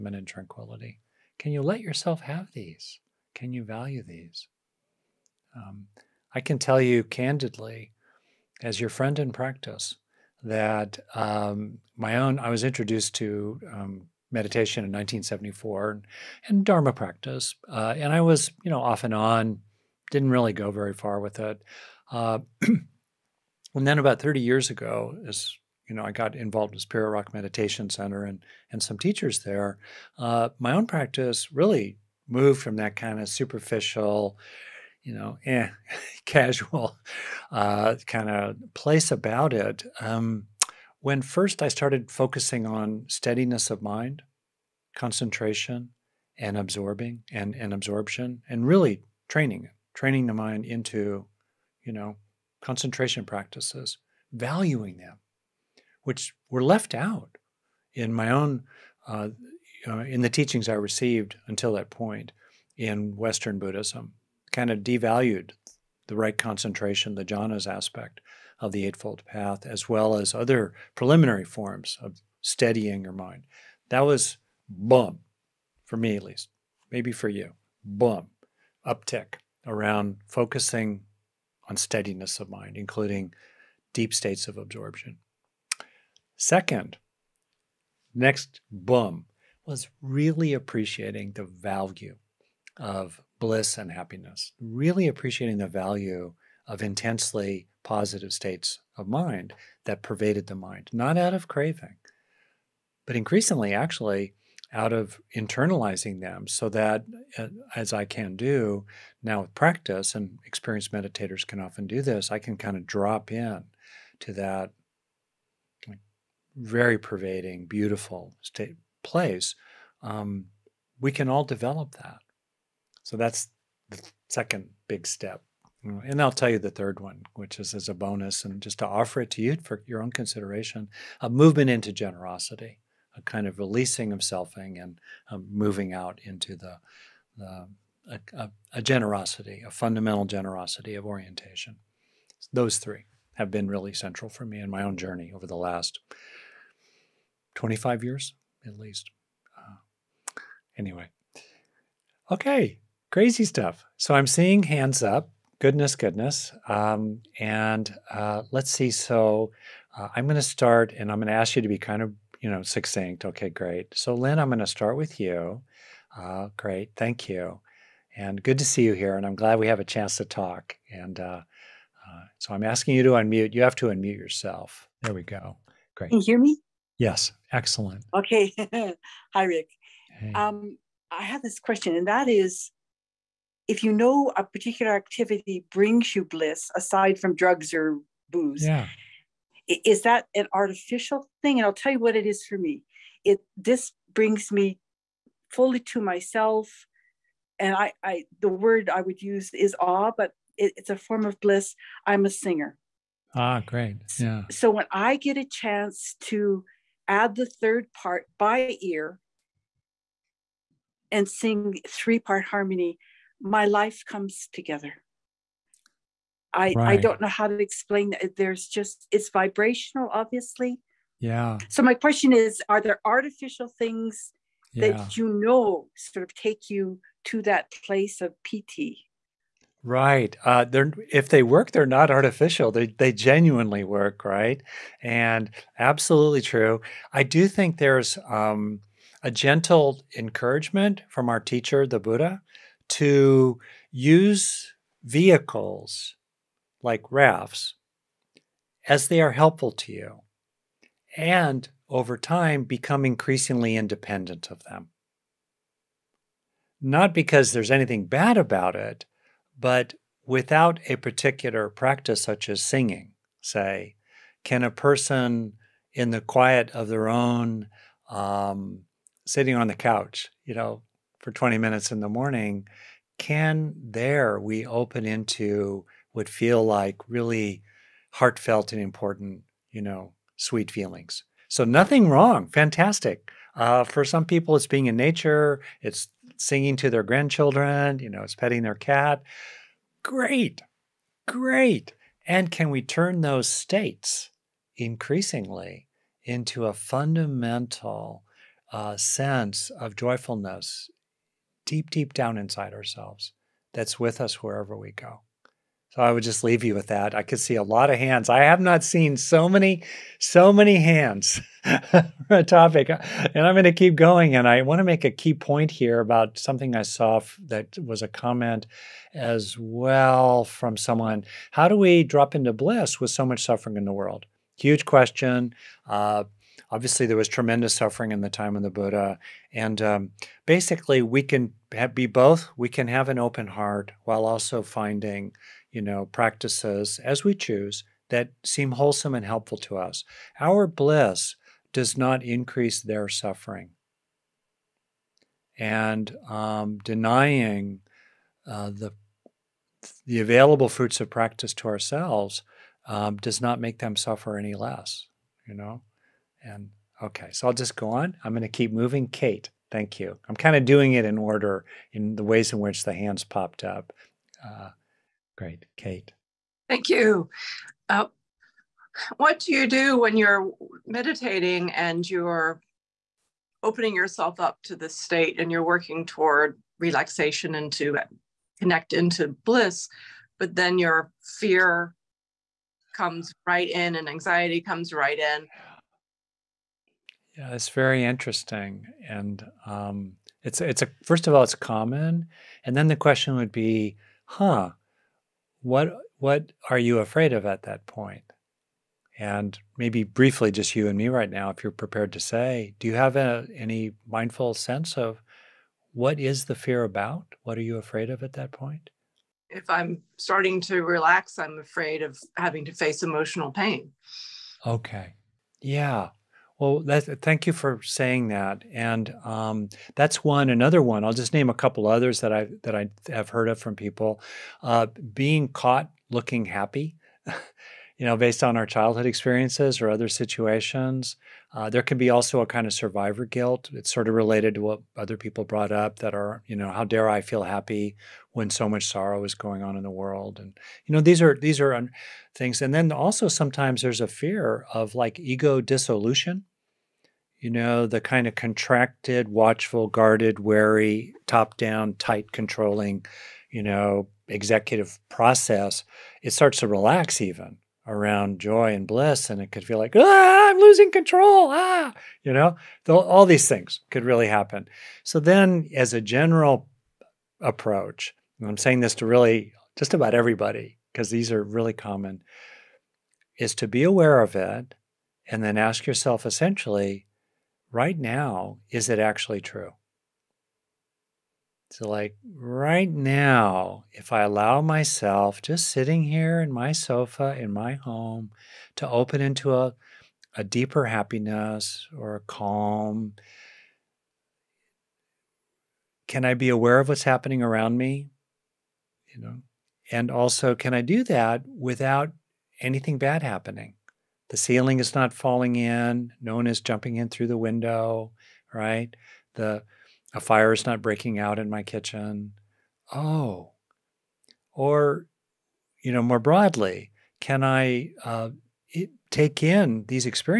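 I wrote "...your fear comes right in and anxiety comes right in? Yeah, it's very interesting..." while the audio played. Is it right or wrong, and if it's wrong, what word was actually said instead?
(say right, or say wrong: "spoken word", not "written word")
right.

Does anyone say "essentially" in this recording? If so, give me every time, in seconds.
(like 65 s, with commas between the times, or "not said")
476 s.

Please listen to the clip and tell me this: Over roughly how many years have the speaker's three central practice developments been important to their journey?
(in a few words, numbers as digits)
25.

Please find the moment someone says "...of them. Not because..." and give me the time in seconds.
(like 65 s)
254 s.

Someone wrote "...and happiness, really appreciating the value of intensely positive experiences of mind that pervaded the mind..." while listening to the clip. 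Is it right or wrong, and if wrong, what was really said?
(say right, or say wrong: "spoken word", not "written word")
wrong: "states", not "experiences".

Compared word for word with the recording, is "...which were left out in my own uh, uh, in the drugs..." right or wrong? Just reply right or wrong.
wrong.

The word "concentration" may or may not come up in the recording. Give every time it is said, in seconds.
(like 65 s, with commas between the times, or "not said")
44 s, 52 s, 66 s.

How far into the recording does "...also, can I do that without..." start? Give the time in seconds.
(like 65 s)
500 s.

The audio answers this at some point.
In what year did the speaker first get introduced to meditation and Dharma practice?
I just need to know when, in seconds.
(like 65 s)
14 s.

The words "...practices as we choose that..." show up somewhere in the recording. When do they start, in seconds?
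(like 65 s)
336 s.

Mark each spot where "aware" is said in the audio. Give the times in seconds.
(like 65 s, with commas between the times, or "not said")
473 s, 496 s.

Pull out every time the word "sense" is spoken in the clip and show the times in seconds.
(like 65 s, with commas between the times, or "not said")
298 s, 404 s.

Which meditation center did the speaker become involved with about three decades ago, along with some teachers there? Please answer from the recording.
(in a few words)
Spirit Rock Meditation Center.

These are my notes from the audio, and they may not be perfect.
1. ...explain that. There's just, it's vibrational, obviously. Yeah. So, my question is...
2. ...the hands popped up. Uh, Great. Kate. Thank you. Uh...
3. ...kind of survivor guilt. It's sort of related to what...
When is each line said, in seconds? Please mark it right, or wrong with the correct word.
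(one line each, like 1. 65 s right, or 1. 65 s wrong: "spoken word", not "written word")
1. 217 s right
2. 362 s right
3. 432 s right.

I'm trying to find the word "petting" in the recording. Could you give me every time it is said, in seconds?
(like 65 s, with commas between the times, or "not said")
288 s.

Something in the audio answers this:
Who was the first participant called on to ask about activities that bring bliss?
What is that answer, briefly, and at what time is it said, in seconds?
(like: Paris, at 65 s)
Lynn, at 164 s.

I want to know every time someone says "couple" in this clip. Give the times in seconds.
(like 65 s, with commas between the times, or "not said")
421 s.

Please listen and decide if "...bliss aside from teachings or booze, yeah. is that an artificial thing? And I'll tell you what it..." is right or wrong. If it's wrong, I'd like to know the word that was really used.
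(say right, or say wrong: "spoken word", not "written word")
wrong: "drugs", not "teachings".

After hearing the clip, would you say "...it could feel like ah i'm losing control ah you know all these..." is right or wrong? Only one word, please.
right.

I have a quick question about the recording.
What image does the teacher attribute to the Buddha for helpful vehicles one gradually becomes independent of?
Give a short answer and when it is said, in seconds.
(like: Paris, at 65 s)
rafts, at 247 s.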